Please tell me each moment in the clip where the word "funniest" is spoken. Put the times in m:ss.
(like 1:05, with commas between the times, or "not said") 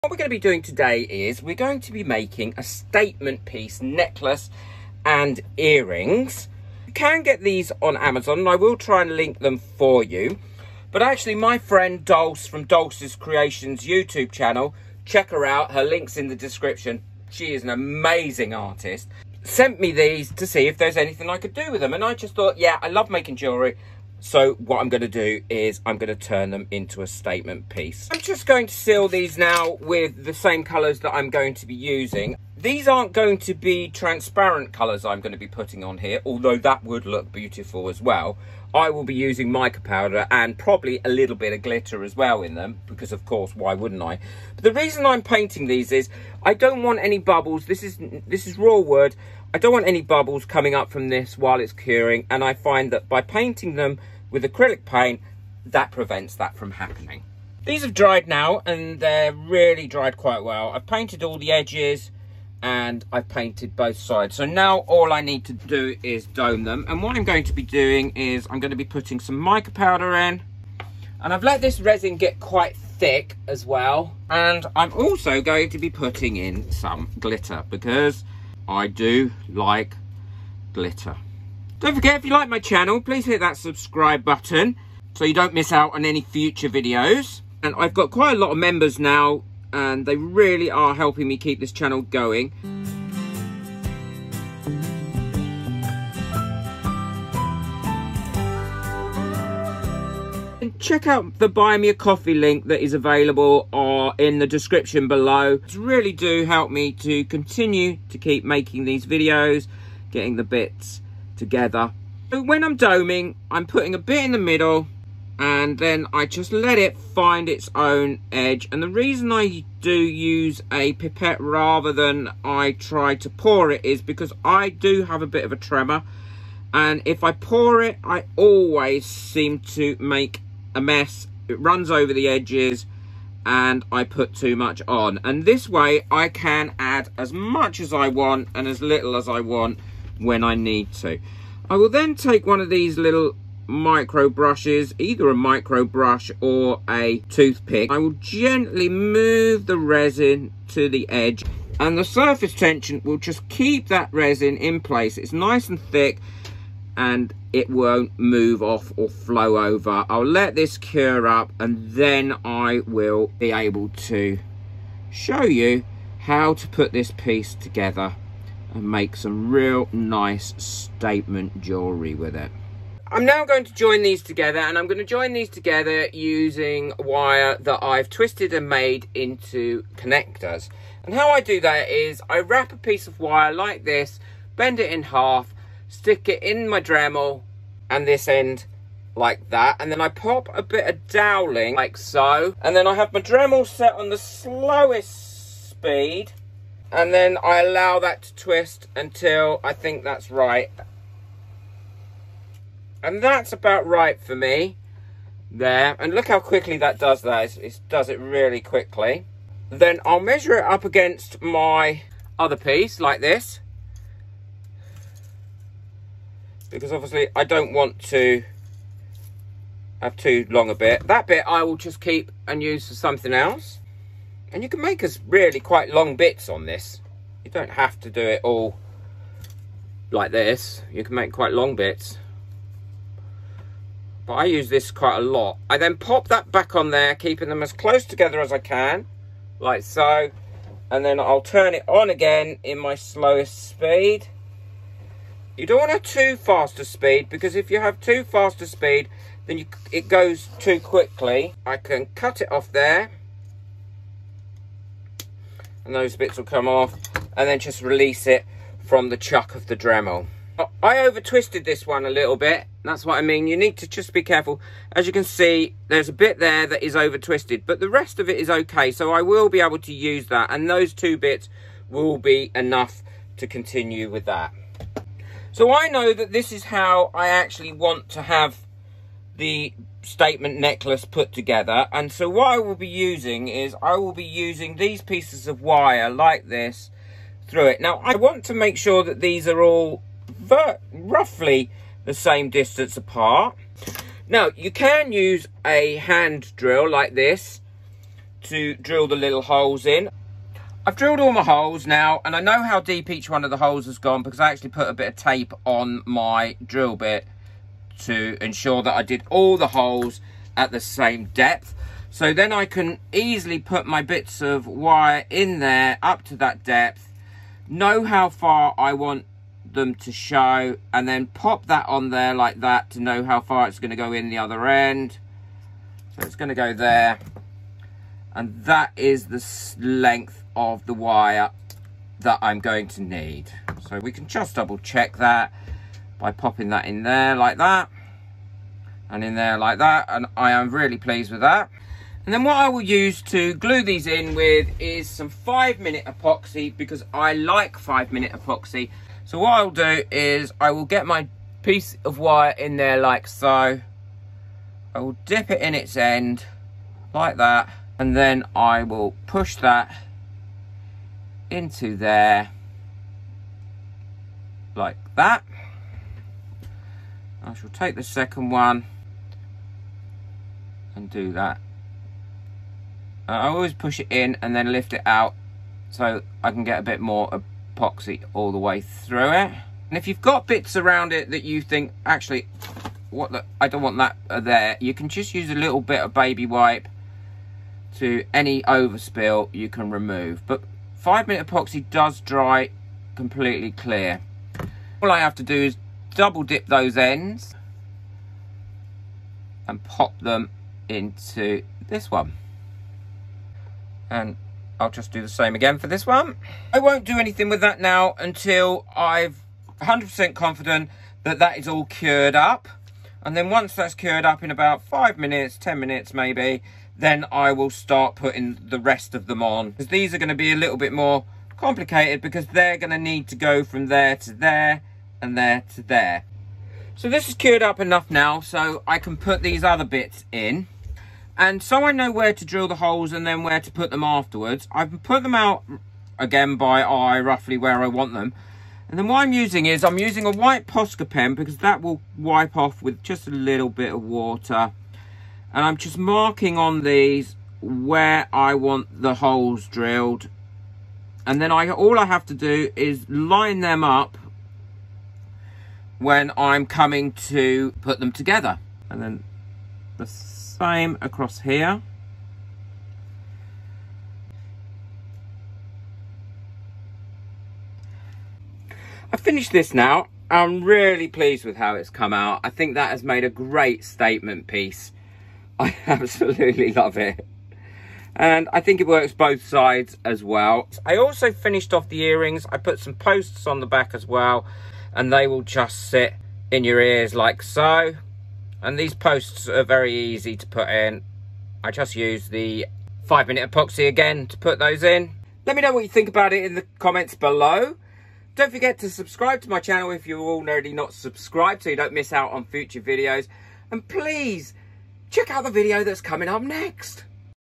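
not said.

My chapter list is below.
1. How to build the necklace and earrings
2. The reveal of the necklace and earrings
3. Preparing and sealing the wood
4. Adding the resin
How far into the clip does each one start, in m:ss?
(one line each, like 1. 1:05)
1. 2:53
2. 7:48
3. 0:32
4. 1:14.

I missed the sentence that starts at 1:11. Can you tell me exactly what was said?
And I've let this resin get quite thick as well.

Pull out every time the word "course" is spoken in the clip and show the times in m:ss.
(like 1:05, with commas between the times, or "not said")
0:43.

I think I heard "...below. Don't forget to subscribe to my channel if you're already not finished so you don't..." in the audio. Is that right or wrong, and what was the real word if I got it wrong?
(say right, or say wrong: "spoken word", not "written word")
wrong: "subscribed", not "finished".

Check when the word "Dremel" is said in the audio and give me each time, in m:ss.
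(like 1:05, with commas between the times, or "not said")
3:06, 3:13, 4:19.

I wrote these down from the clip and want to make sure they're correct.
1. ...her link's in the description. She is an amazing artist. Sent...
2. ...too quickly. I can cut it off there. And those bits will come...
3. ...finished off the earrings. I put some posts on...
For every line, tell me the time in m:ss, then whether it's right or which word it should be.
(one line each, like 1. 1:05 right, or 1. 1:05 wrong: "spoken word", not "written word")
1. 0:15 right
2. 4:10 right
3. 8:01 right.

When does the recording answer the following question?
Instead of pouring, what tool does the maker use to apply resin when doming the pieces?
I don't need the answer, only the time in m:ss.
2:00.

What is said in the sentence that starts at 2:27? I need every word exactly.
I will gently move the resin to the edge and the surface tension will just keep that resin in place.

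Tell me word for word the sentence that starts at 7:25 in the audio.
And I'm just marking on these where I want the holes drilled.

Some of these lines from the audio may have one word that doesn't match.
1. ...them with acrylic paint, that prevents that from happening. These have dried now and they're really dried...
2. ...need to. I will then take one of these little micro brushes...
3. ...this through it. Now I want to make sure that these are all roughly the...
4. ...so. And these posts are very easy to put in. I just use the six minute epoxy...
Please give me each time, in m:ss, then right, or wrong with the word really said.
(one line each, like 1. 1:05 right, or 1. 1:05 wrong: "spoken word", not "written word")
1. 0:53 right
2. 2:20 right
3. 4:46 right
4. 8:07 wrong: "five", not "six".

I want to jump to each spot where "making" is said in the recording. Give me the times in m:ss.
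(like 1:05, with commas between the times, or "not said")
0:02, 0:23, 1:48.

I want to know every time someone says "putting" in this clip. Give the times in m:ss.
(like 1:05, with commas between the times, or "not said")
0:35, 1:08, 1:15, 1:53, 6:58.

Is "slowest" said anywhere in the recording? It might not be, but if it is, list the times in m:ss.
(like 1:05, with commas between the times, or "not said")
3:14, 4:02.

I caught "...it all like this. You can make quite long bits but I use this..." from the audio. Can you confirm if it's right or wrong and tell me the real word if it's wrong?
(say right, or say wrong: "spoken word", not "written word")
right.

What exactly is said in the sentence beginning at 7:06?
So this is cured up enough now, so I can put these other bits in.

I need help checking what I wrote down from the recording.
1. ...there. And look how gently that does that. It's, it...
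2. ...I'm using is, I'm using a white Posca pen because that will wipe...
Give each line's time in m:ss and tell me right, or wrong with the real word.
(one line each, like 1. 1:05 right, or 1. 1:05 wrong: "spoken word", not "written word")
1. 3:25 wrong: "quickly", not "gently"
2. 7:19 right.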